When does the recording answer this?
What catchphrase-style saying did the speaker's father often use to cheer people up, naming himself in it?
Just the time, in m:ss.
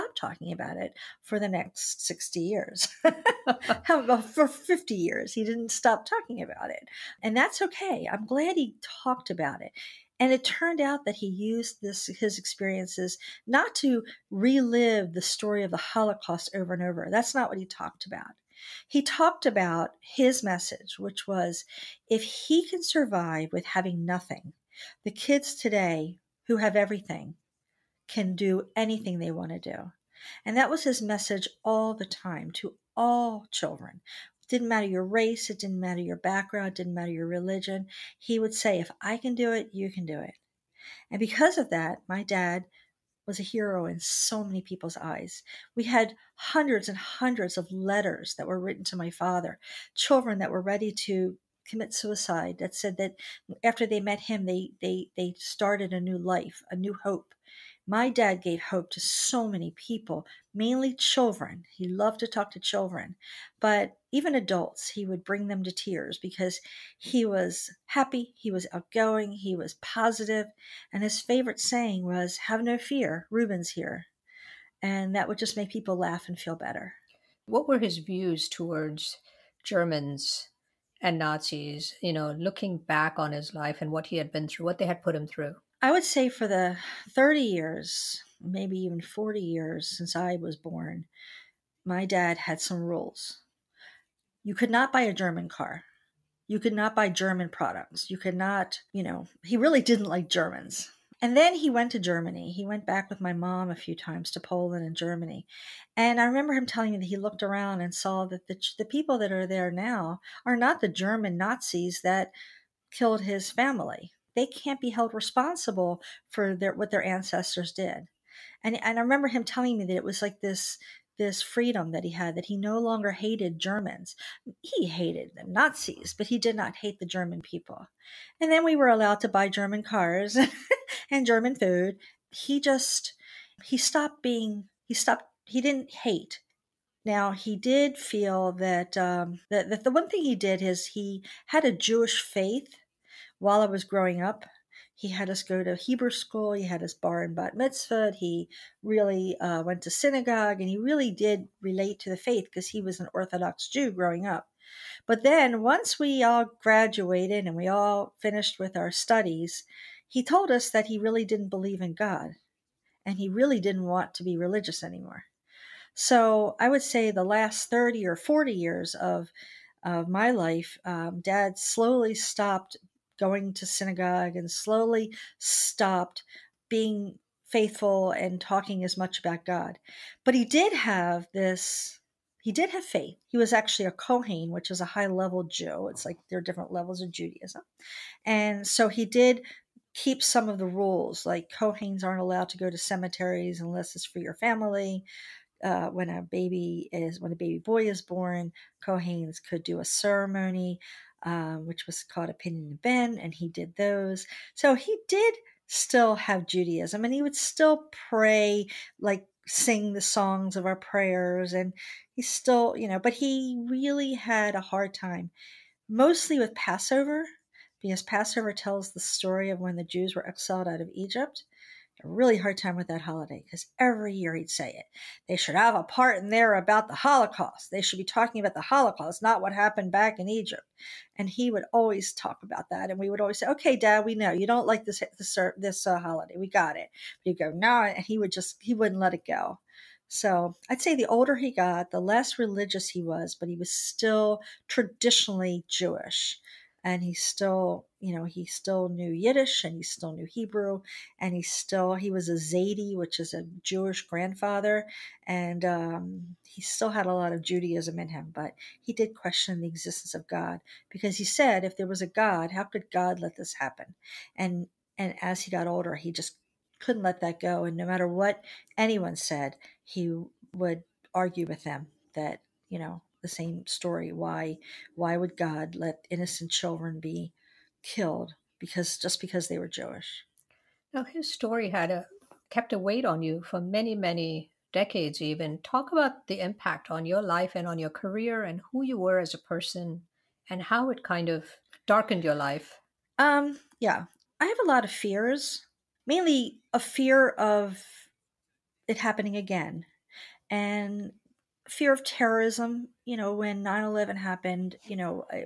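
1:12.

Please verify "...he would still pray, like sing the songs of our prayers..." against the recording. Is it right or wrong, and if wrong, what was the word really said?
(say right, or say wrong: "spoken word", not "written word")
right.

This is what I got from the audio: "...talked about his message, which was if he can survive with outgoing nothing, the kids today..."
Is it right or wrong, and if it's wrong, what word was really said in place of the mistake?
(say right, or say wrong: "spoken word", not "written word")
wrong: "having", not "outgoing".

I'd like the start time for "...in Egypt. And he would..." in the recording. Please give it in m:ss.
3:50.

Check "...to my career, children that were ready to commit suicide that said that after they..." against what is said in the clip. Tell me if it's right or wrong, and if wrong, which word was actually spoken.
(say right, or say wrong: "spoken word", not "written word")
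wrong: "father", not "career".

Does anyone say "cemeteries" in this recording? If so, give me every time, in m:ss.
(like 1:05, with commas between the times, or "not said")
3:12.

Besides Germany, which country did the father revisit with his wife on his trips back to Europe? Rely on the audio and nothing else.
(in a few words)
Poland.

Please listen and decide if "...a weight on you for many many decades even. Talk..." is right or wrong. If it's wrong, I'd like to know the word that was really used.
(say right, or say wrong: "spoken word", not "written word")
right.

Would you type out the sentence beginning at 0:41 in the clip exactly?
And because of that, my dad was a hero in so many people's eyes.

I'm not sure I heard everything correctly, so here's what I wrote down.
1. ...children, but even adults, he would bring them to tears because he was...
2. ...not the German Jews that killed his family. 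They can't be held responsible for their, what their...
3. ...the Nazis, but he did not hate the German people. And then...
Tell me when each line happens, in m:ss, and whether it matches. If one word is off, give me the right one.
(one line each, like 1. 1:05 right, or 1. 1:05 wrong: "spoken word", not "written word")
1. 1:02 right
2. 1:50 wrong: "Nazis", not "Jews"
3. 2:05 right.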